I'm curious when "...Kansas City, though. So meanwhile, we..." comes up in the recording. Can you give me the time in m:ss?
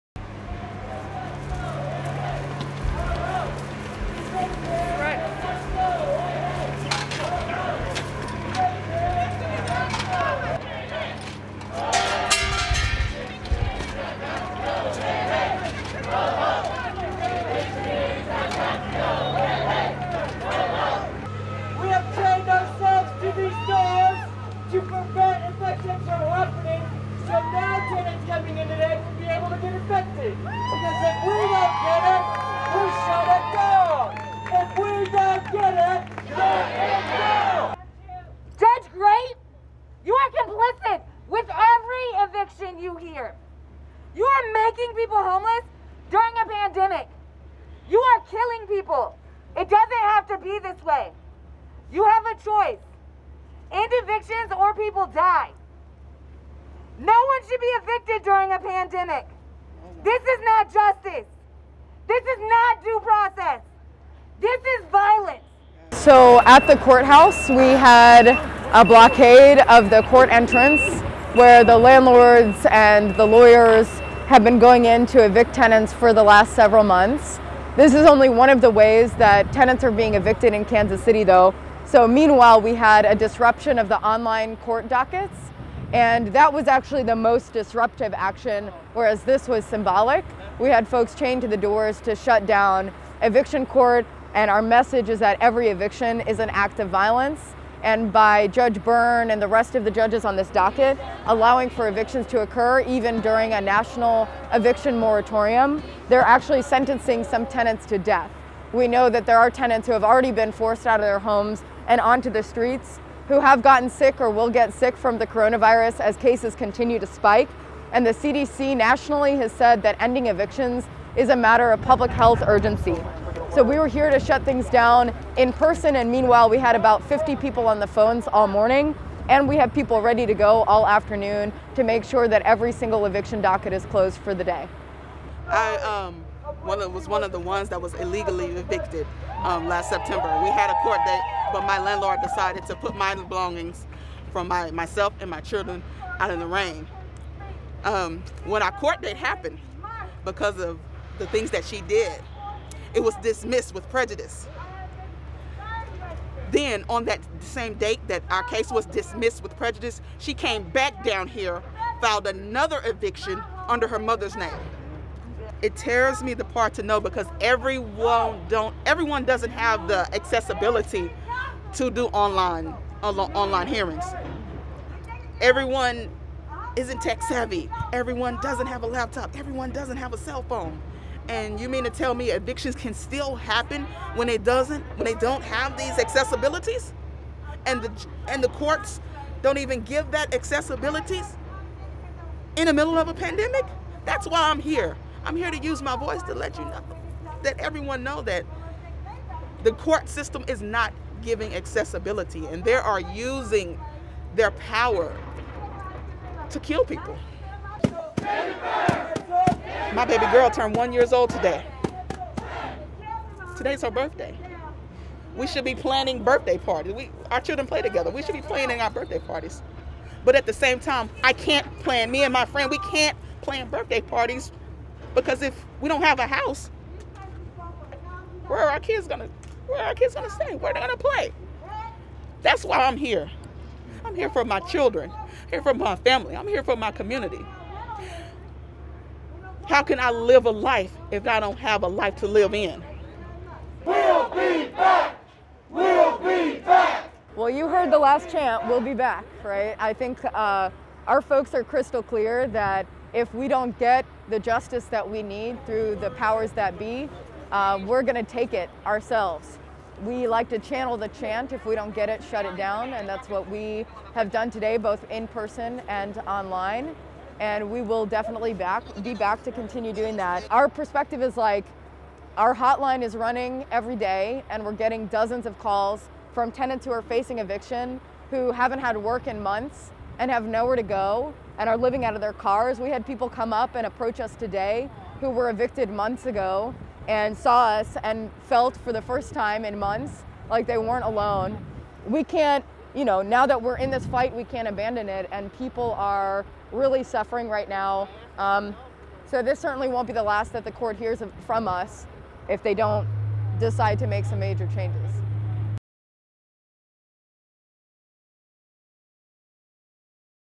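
1:20.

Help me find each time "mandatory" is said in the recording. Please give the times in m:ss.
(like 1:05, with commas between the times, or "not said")
not said.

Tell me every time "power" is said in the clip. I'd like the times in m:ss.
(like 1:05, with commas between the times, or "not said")
3:24, 4:16.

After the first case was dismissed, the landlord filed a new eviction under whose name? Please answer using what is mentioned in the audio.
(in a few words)
Her mother's.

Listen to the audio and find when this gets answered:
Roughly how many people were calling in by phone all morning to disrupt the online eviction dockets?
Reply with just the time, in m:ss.
2:06.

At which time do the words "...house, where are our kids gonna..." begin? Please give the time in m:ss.
3:46.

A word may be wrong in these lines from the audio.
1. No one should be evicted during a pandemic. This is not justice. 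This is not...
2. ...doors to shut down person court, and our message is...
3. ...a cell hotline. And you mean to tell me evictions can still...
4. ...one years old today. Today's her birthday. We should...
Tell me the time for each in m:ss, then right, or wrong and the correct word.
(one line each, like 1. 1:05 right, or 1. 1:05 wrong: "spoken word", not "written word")
1. 0:56 right
2. 1:31 wrong: "eviction", not "person"
3. 3:00 wrong: "phone", not "hotline"
4. 3:30 right.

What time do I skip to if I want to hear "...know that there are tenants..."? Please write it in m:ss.
1:48.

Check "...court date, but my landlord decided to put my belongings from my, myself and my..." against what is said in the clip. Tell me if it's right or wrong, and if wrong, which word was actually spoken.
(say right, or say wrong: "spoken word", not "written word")
right.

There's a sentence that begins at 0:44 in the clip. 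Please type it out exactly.
You are making people homeless during a pandemic.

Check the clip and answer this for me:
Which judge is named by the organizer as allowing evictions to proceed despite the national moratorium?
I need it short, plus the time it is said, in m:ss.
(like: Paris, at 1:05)
Judge Byrne, at 1:38.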